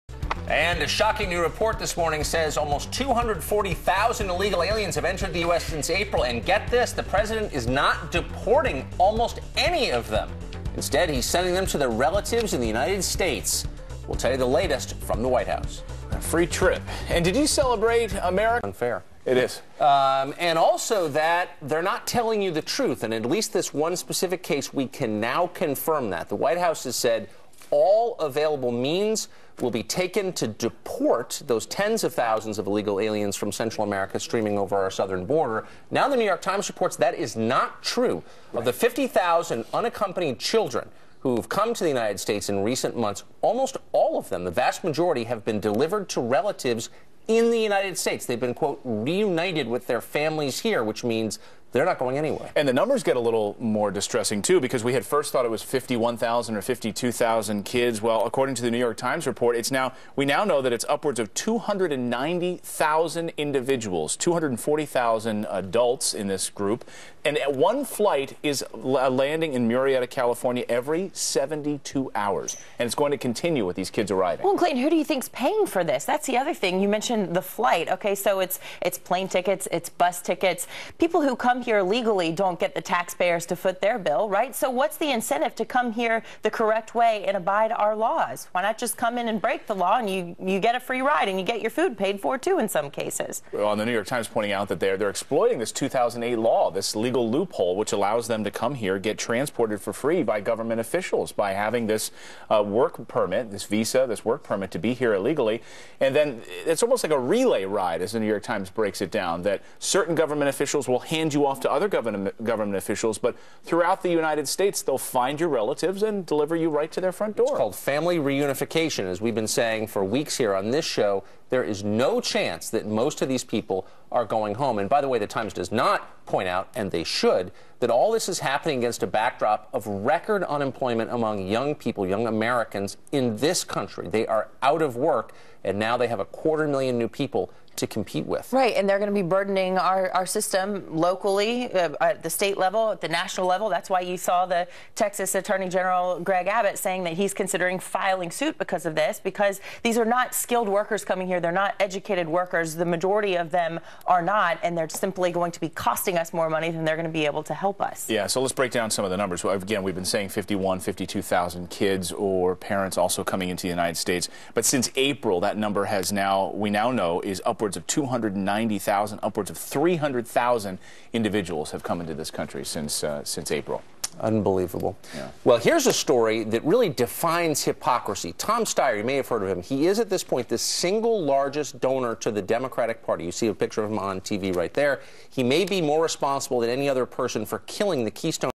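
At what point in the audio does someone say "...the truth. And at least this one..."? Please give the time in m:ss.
0:22.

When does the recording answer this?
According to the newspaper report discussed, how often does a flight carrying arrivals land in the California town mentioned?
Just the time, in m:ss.
1:10.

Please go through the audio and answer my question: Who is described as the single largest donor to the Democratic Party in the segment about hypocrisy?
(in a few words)
Tom Steyer.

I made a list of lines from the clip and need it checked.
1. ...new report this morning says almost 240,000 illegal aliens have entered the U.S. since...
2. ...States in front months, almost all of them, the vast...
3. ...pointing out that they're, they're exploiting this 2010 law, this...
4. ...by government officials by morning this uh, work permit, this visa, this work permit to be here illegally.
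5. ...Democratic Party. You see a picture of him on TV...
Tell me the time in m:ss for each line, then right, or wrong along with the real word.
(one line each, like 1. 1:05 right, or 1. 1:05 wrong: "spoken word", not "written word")
1. 0:01 right
2. 0:42 wrong: "recent", not "front"
3. 1:34 wrong: "2008", not "2010"
4. 1:40 wrong: "having", not "morning"
5. 3:02 right.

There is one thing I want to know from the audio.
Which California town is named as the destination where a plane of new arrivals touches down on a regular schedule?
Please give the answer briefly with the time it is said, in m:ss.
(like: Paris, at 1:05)
Murrieta, at 1:09.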